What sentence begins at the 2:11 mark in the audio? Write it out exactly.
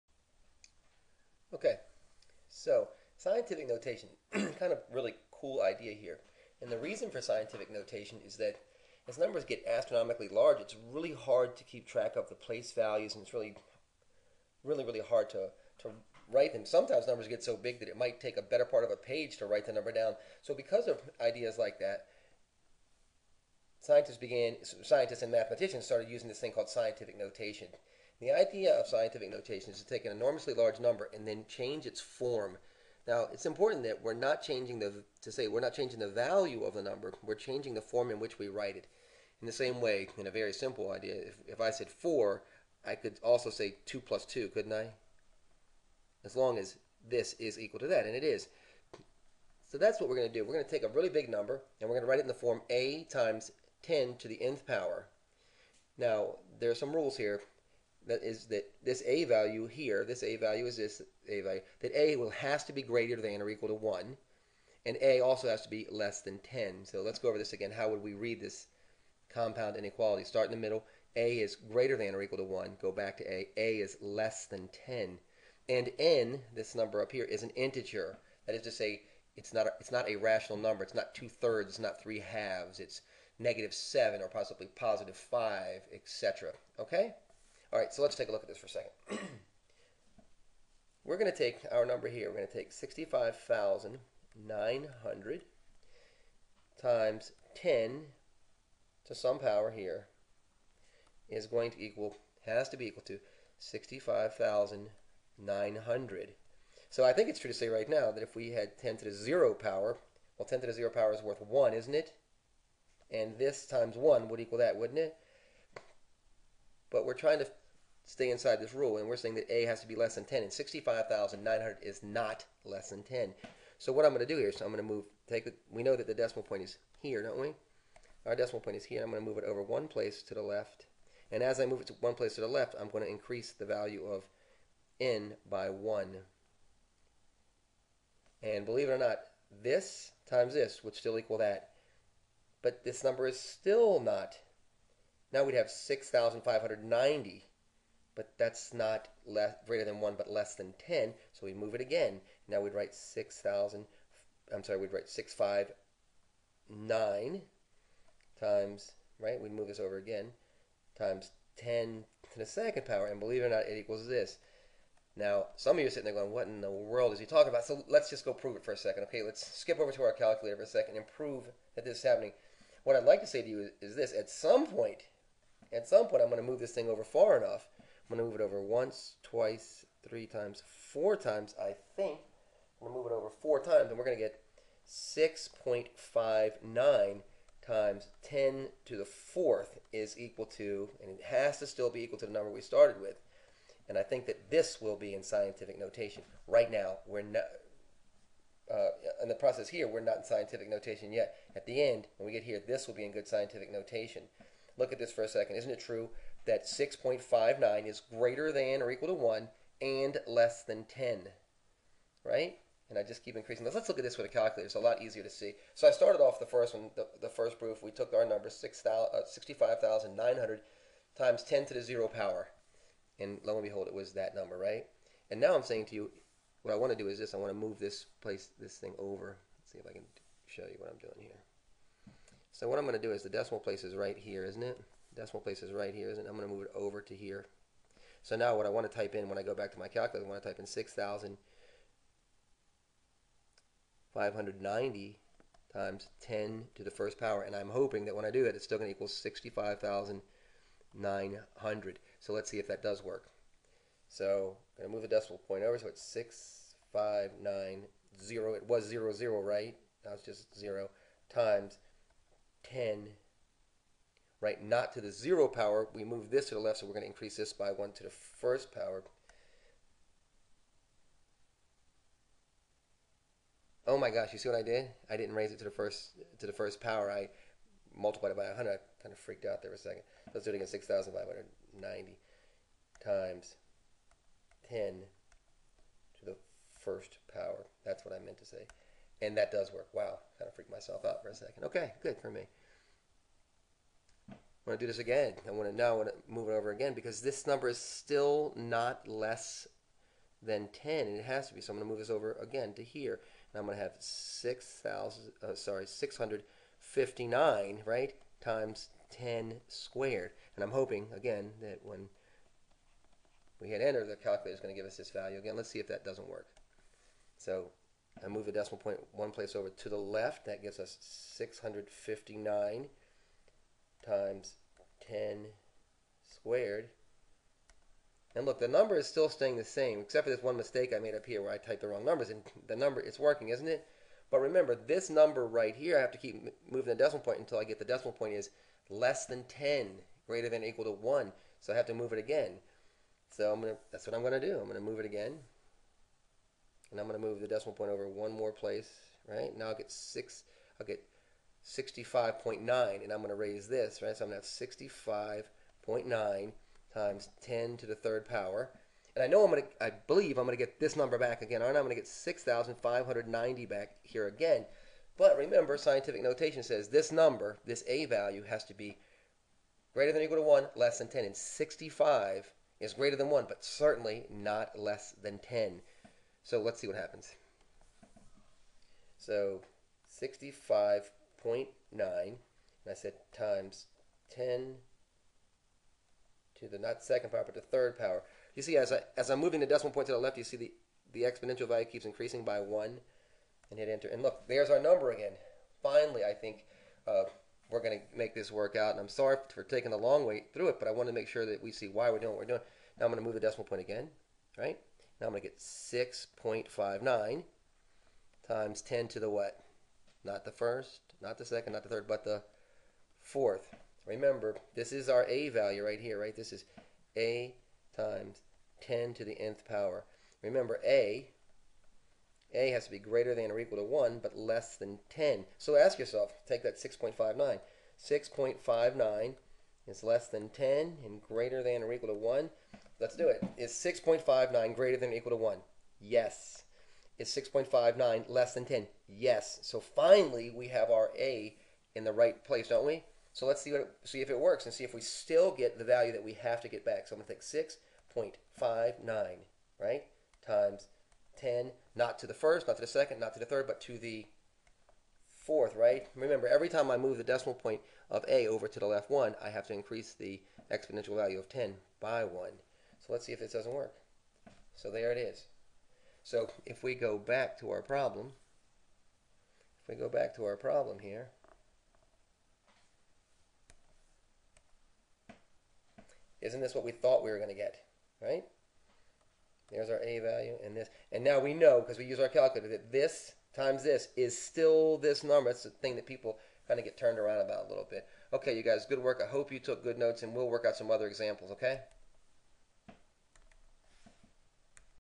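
And as I move it to one place to the left, I'm going to increase the value of n by 1.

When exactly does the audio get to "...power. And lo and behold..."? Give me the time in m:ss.
3:42.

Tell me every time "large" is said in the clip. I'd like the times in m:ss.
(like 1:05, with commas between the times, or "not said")
0:10, 0:30.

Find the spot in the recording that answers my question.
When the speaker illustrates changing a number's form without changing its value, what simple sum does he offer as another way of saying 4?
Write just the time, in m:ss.
0:43.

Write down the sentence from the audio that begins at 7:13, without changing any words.
Is 6.59 greater than or equal to 1?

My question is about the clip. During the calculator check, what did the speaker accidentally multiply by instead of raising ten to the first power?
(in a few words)
100.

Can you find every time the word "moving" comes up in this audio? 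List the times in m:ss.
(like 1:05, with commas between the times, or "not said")
5:36, 6:29.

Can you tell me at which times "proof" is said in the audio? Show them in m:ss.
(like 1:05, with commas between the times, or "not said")
3:37.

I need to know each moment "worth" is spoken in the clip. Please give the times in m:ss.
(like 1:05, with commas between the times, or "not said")
1:51.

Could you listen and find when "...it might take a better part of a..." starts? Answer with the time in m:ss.
0:17.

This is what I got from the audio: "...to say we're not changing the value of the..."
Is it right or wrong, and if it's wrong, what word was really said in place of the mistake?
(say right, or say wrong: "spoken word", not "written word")
right.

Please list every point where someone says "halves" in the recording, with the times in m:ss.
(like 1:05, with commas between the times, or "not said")
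1:22.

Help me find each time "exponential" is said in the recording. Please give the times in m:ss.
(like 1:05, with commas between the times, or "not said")
6:31, 7:40.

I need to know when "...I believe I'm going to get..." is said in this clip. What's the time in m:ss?
5:59.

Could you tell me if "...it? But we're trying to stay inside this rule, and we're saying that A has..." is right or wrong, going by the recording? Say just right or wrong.
right.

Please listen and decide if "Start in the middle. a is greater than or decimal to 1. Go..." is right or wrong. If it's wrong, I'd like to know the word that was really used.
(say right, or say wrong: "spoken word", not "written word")
wrong: "equal", not "decimal".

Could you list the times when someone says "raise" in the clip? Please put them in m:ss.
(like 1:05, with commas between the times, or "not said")
4:35, 5:53.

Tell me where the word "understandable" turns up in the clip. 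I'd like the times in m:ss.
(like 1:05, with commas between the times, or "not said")
not said.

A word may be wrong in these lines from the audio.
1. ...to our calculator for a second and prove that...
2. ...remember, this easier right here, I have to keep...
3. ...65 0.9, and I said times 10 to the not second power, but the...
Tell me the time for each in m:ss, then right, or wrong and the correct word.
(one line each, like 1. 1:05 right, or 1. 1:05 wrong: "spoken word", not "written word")
1. 2:49 right
2. 5:34 wrong: "number", not "easier"
3. 6:20 right.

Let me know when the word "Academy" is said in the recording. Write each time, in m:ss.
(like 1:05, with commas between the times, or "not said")
not said.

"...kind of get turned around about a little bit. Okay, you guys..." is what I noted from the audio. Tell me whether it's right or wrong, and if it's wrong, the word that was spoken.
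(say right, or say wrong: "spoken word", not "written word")
right.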